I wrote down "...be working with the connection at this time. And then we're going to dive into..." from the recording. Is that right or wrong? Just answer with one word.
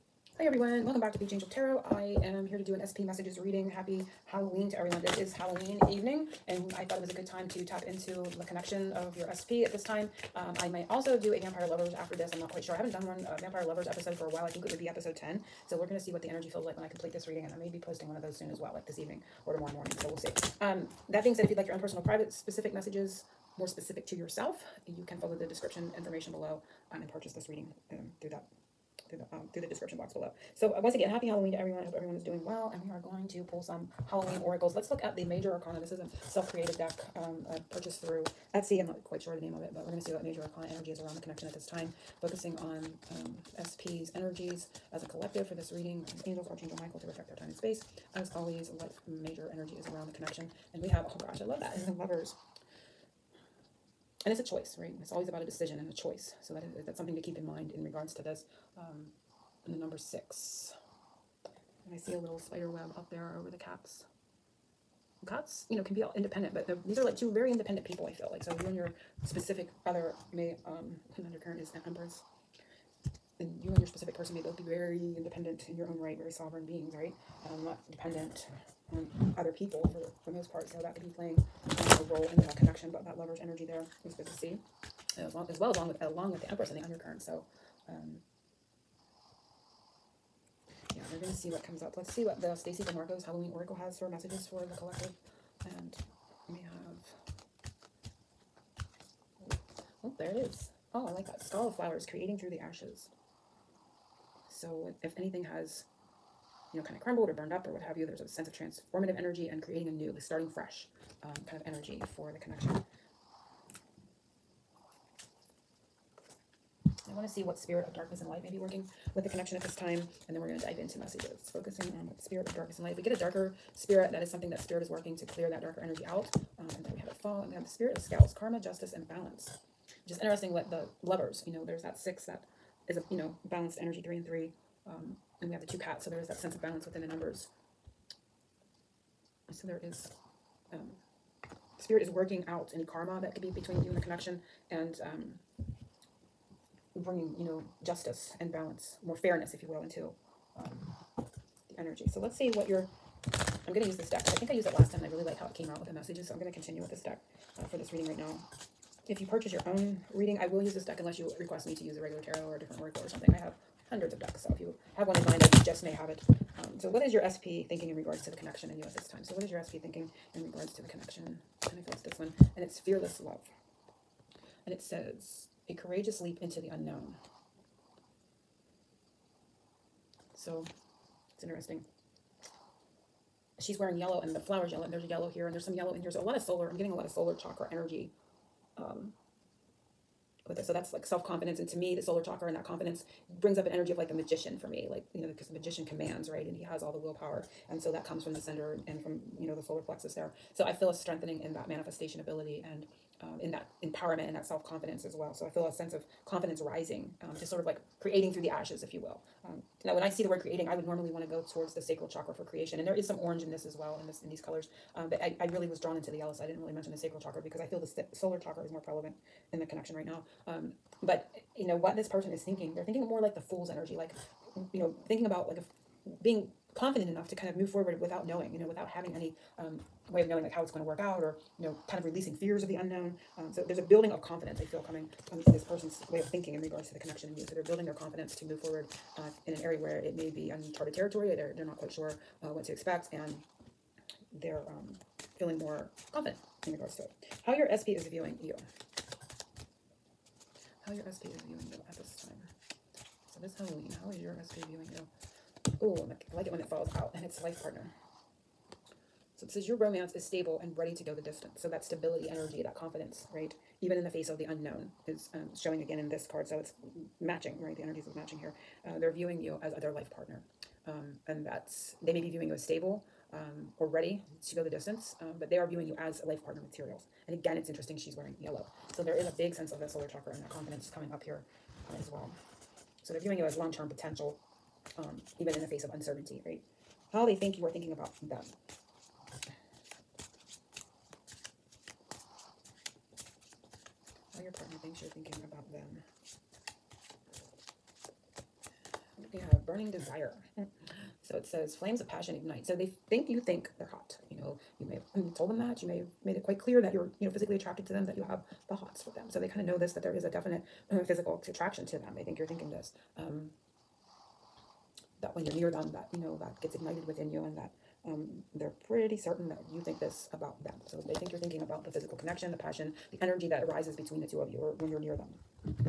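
right.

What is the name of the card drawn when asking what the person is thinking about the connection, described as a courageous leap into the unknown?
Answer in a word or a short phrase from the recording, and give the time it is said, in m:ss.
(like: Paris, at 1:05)
Fearless Love, at 2:52.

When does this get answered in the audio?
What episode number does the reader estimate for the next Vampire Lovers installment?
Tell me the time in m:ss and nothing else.
0:14.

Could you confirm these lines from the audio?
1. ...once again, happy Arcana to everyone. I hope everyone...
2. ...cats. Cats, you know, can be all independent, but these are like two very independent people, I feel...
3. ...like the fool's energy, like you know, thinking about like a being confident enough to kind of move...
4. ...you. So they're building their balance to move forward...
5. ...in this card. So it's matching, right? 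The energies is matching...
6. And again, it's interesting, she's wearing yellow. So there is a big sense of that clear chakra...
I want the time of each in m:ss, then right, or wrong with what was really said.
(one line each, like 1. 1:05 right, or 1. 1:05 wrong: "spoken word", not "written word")
1. 0:30 wrong: "Halloween", not "Arcana"
2. 1:03 right
3. 3:43 right
4. 3:57 wrong: "confidence", not "balance"
5. 4:25 right
6. 4:37 wrong: "solar", not "clear".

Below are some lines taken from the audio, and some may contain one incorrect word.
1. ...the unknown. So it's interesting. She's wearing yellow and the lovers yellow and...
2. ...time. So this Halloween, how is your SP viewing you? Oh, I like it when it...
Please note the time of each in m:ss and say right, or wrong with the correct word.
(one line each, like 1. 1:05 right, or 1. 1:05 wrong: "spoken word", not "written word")
1. 2:56 wrong: "flowers", not "lovers"
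2. 4:12 right.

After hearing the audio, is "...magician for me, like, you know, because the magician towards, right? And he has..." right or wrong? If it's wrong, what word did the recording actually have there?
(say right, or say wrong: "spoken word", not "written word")
wrong: "commands", not "towards".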